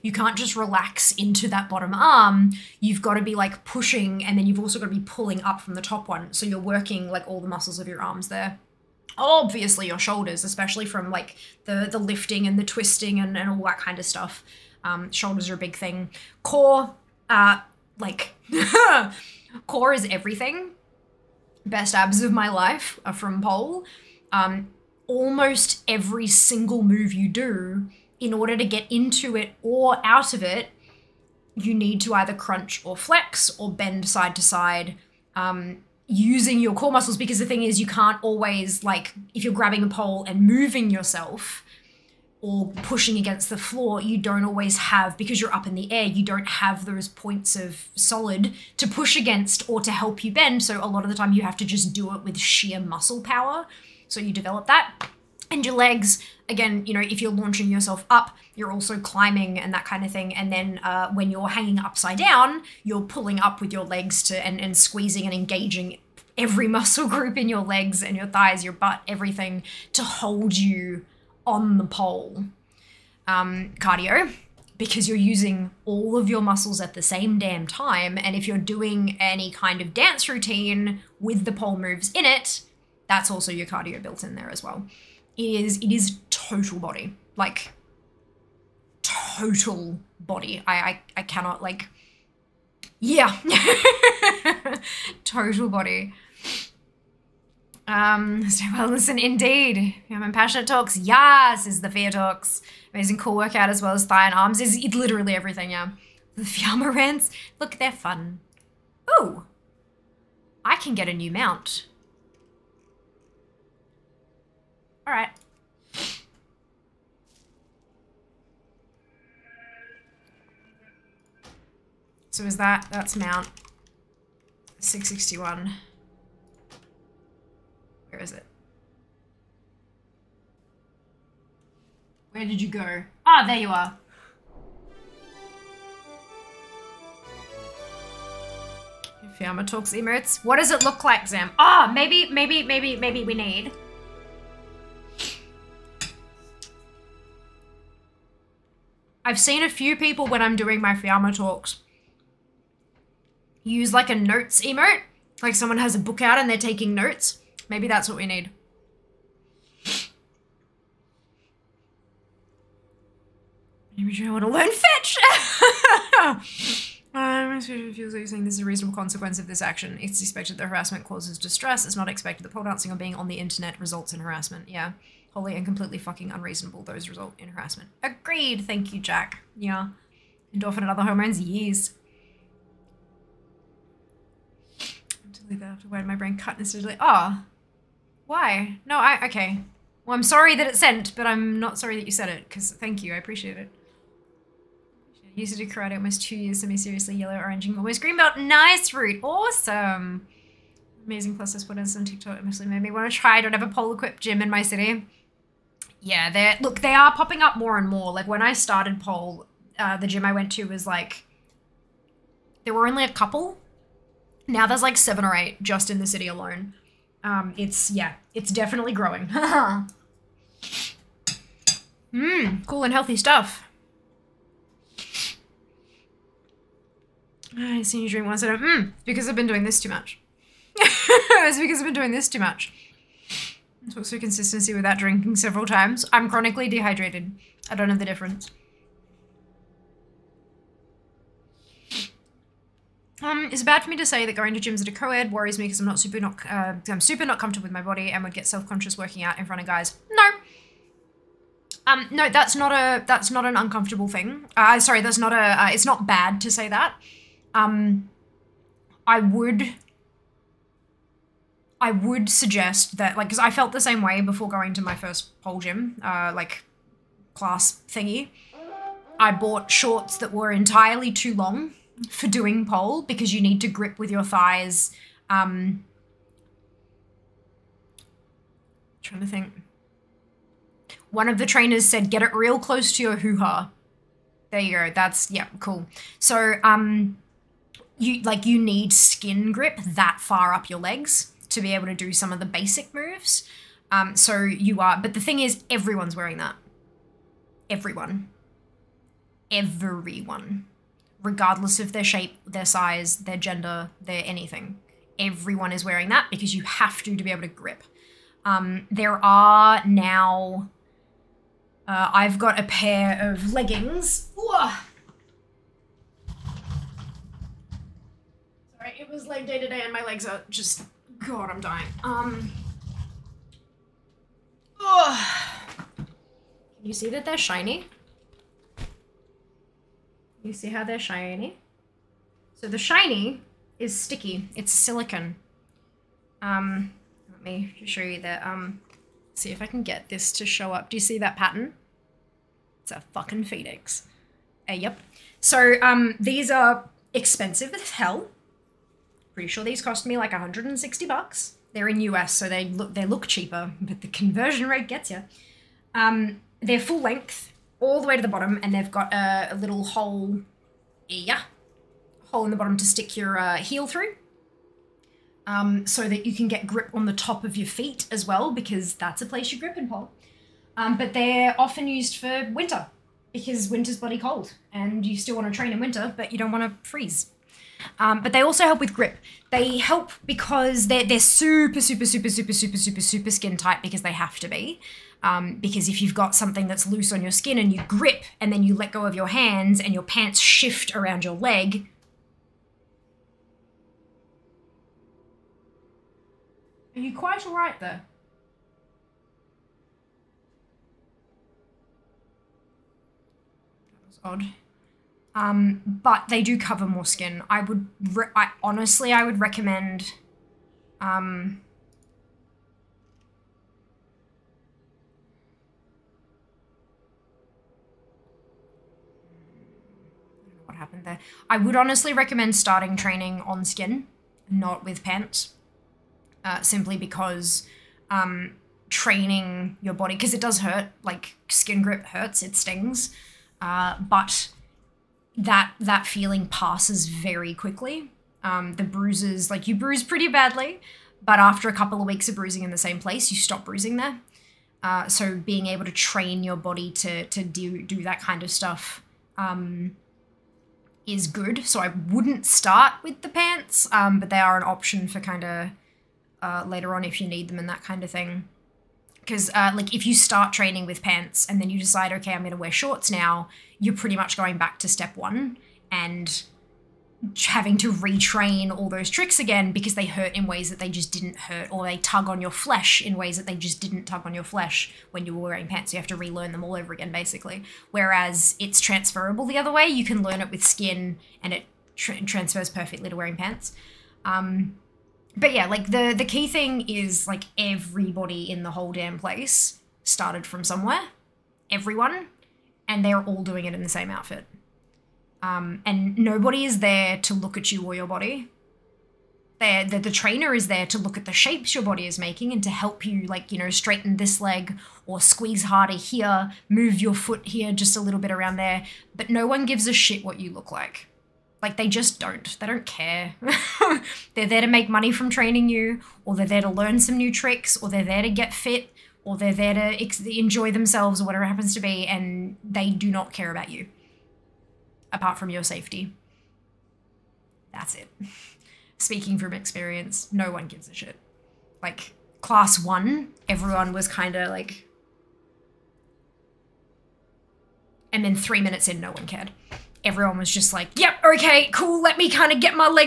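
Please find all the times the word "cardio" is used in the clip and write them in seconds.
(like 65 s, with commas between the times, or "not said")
73 s, 83 s.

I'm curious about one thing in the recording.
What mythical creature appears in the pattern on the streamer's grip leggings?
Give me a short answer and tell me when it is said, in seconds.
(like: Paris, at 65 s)
phoenix, at 343 s.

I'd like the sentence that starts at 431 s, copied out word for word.
Like skin grip hurts, it stings, uh, but that that feeling passes very quickly.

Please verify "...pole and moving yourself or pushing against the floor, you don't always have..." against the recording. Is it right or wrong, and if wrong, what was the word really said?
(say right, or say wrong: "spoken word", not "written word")
right.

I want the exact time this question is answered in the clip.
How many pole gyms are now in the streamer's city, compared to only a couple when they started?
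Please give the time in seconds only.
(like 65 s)
214 s.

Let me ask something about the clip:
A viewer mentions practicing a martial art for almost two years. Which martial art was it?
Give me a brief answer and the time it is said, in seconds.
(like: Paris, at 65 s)
karate, at 195 s.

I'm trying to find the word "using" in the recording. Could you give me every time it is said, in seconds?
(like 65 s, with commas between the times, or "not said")
36 s, 75 s.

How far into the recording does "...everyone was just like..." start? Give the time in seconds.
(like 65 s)
540 s.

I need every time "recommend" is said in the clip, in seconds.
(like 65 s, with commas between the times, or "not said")
409 s, 422 s.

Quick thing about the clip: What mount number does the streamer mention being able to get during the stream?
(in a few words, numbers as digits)
661.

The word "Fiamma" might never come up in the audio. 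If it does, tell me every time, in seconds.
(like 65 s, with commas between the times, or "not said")
106 s, 139 s, 150 s.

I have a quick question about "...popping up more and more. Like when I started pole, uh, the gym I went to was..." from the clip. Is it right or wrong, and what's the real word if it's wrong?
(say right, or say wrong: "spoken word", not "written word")
right.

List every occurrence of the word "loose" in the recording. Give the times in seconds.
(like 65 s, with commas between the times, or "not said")
386 s.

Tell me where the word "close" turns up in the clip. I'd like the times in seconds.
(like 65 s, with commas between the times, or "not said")
282 s.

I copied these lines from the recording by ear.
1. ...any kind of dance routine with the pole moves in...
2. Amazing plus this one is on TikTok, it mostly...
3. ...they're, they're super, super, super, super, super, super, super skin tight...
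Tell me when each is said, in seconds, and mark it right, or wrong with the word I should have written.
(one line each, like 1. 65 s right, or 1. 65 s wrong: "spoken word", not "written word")
1. 79 s right
2. 201 s right
3. 380 s right.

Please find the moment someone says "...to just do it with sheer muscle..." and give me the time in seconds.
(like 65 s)
51 s.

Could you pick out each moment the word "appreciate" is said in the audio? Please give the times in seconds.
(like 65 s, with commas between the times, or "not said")
193 s.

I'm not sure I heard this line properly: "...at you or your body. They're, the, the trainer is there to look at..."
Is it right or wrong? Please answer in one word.
right.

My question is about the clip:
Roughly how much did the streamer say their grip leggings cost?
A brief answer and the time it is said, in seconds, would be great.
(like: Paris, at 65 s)
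160 bucks, at 350 s.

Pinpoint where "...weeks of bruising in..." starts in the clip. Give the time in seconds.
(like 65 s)
442 s.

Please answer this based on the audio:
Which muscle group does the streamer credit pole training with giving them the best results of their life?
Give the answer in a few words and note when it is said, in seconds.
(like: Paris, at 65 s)
abs, at 21 s.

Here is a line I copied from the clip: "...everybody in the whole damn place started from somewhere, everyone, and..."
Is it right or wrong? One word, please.
right.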